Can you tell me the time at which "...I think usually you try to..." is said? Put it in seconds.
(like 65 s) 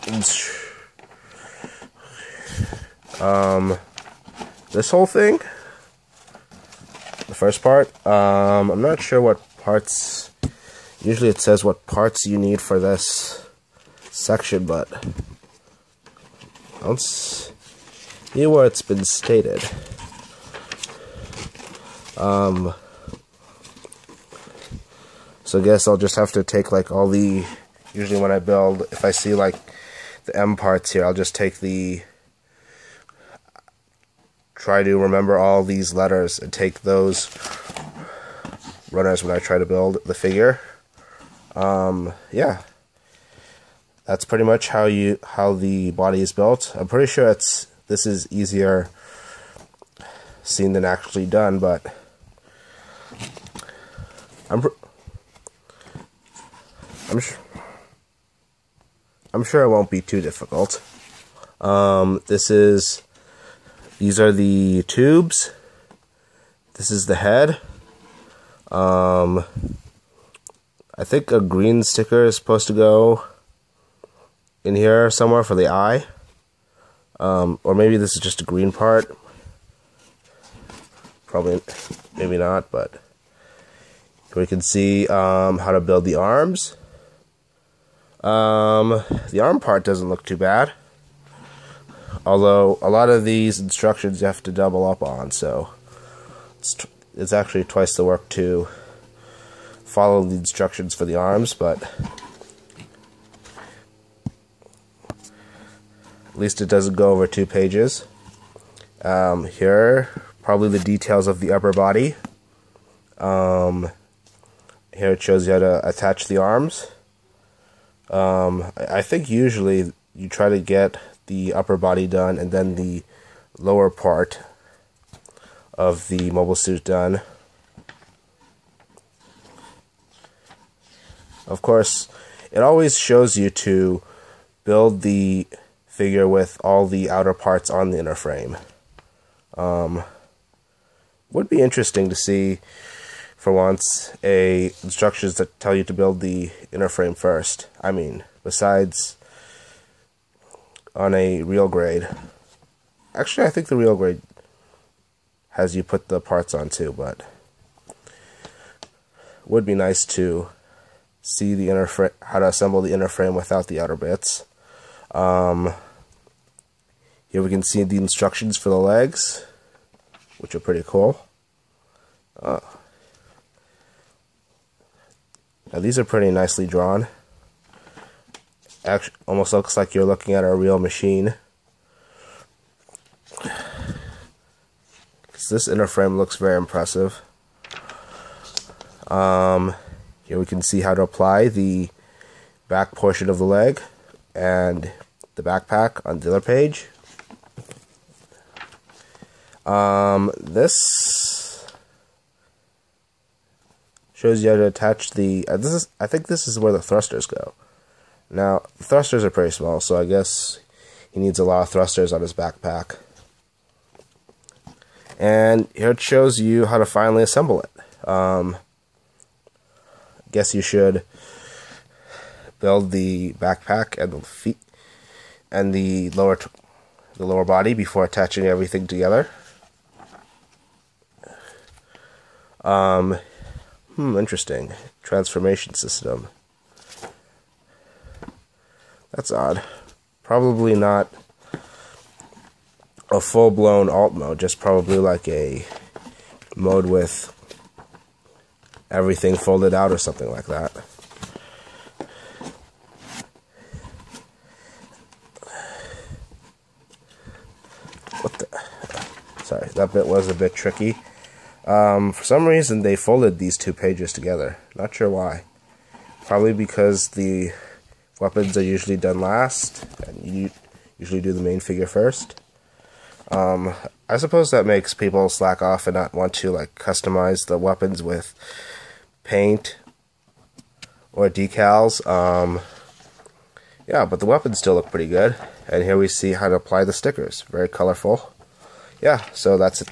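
118 s.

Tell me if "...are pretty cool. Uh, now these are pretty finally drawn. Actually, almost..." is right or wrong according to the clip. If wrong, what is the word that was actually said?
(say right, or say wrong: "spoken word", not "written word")
wrong: "nicely", not "finally".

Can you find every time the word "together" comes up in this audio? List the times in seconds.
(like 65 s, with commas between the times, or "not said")
228 s, 264 s.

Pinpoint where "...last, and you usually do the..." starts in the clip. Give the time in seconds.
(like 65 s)
269 s.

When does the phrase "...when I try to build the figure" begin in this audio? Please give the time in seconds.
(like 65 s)
39 s.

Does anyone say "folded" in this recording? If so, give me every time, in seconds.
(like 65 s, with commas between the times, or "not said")
249 s, 262 s.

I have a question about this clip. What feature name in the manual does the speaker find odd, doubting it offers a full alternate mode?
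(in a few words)
Transformation system.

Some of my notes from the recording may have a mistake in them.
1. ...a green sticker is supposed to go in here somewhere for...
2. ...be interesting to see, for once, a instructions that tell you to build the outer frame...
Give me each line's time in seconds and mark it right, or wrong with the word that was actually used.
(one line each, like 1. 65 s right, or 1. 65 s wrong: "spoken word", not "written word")
1. 71 s right
2. 141 s wrong: "inner", not "outer".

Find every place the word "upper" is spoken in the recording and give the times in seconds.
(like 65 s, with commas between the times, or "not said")
111 s, 121 s.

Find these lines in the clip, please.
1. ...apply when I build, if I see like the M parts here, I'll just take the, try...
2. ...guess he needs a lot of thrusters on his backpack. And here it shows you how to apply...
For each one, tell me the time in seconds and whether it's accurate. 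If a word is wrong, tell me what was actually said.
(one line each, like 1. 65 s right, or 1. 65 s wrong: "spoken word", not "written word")
1. 27 s wrong: "usually", not "apply"
2. 210 s wrong: "finally", not "apply".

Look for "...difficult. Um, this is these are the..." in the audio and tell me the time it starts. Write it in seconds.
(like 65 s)
60 s.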